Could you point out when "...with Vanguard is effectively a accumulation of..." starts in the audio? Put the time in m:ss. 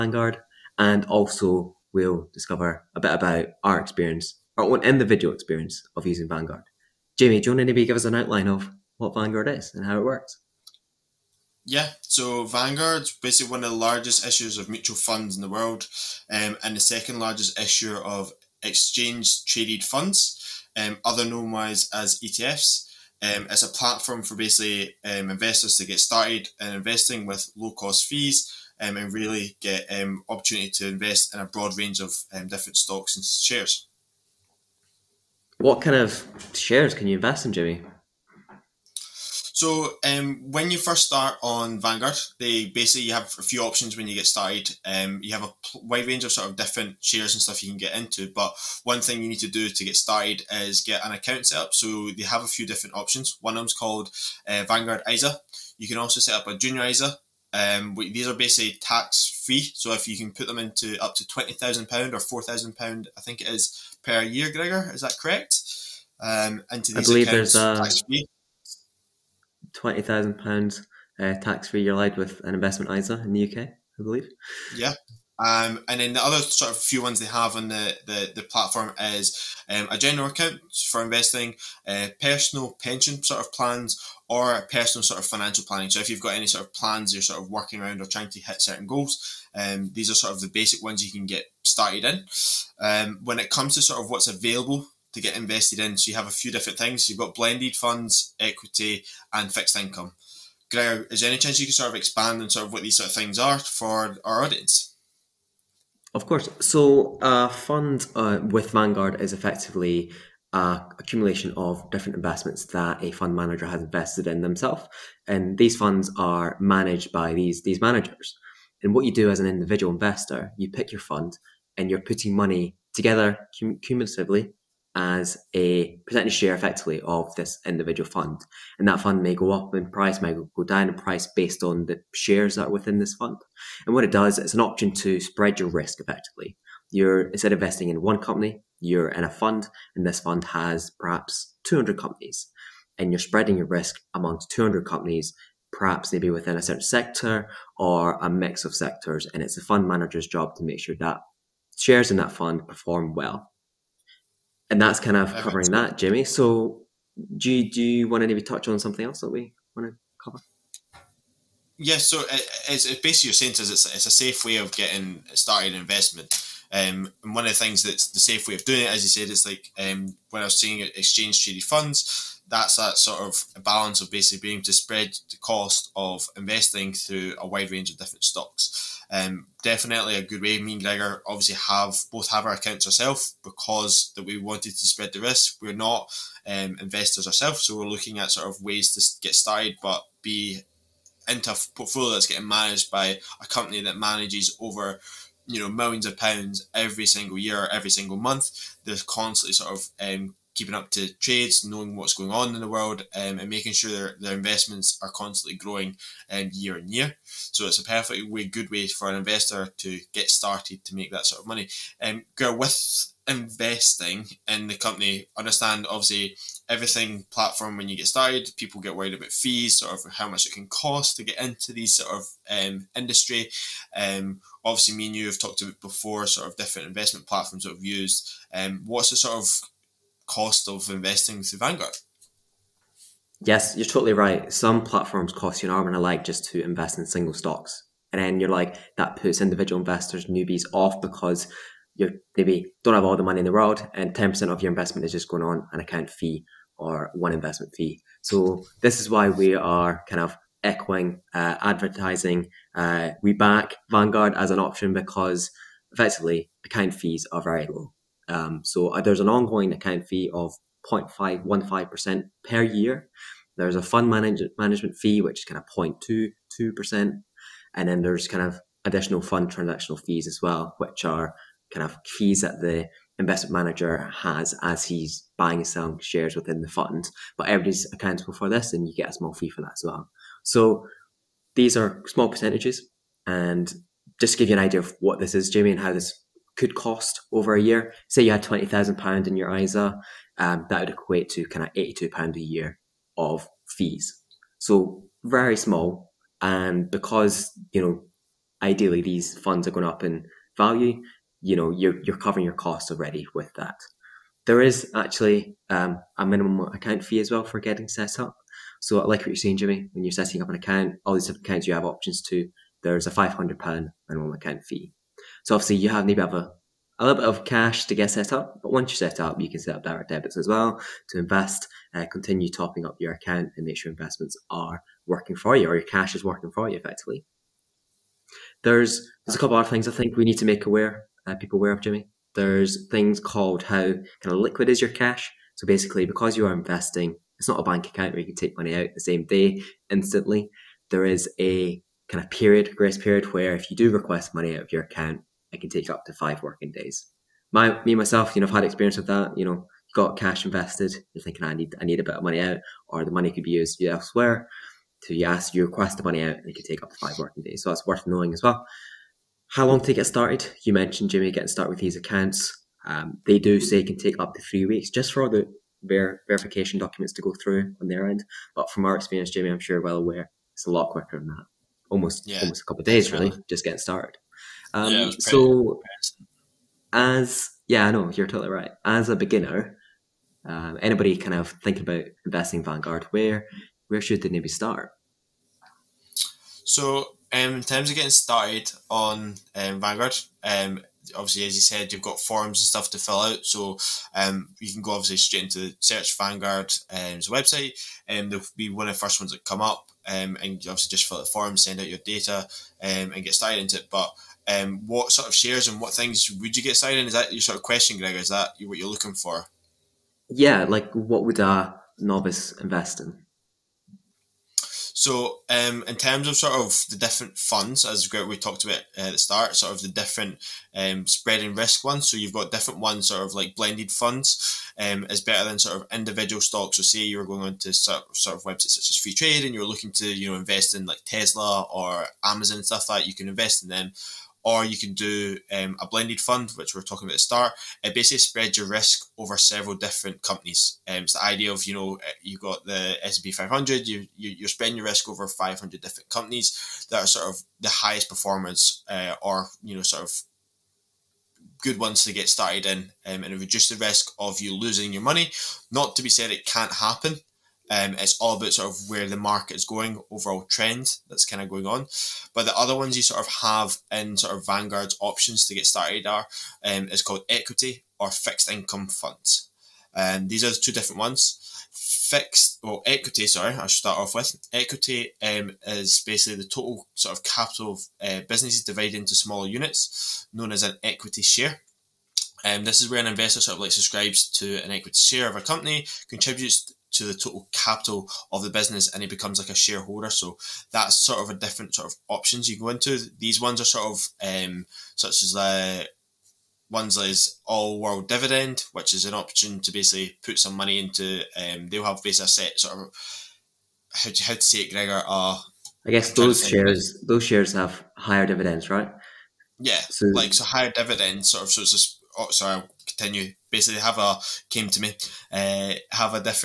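1:48.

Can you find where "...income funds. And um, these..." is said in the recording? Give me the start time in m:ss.
7:48.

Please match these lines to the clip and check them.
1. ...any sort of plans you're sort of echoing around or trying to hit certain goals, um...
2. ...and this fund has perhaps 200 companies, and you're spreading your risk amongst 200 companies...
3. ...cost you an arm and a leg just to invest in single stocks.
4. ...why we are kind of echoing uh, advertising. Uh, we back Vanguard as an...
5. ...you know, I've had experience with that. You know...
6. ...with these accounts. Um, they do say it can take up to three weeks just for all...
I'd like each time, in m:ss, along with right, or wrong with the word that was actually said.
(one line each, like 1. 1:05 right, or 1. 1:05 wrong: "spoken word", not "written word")
1. 1:26 wrong: "working", not "echoing"
2. 2:19 right
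3. 3:55 right
4. 4:09 right
5. 5:48 right
6. 6:01 right.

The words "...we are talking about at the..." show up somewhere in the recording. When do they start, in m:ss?
7:16.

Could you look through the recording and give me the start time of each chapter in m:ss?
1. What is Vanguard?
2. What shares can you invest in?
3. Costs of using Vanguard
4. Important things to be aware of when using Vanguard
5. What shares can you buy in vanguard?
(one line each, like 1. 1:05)
1. 0:11
2. 0:38
3. 3:51
4. 5:37
5. 6:44.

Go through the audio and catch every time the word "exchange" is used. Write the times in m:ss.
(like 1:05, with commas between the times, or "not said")
0:18, 2:50.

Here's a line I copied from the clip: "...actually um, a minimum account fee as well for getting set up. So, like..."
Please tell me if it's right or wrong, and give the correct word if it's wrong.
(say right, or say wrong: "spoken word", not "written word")
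right.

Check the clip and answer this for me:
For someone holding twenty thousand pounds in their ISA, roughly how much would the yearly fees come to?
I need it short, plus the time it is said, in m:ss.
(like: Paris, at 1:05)
£82, at 4:51.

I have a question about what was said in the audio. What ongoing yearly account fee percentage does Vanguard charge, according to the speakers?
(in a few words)
0.515%.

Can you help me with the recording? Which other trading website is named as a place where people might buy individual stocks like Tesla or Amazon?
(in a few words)
Freetrade.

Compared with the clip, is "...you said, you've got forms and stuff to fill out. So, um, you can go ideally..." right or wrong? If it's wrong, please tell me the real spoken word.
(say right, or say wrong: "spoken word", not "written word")
wrong: "obviously", not "ideally".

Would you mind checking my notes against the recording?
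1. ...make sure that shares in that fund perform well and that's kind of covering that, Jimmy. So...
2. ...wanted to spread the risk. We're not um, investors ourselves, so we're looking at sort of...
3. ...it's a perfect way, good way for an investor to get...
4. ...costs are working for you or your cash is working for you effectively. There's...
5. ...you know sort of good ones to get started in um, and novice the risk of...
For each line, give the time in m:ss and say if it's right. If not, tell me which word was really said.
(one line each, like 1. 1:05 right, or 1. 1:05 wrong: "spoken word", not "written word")
1. 2:30 right
2. 3:04 right
3. 3:27 right
4. 5:23 wrong: "investments", not "costs"
5. 7:29 wrong: "reduce", not "novice".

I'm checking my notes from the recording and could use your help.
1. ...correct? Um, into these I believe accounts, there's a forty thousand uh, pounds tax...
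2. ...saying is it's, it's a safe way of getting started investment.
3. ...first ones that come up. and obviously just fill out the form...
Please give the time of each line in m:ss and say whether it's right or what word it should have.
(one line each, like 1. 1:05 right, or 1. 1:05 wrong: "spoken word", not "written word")
1. 1:05 wrong: "twenty", not "forty"
2. 2:43 right
3. 6:38 right.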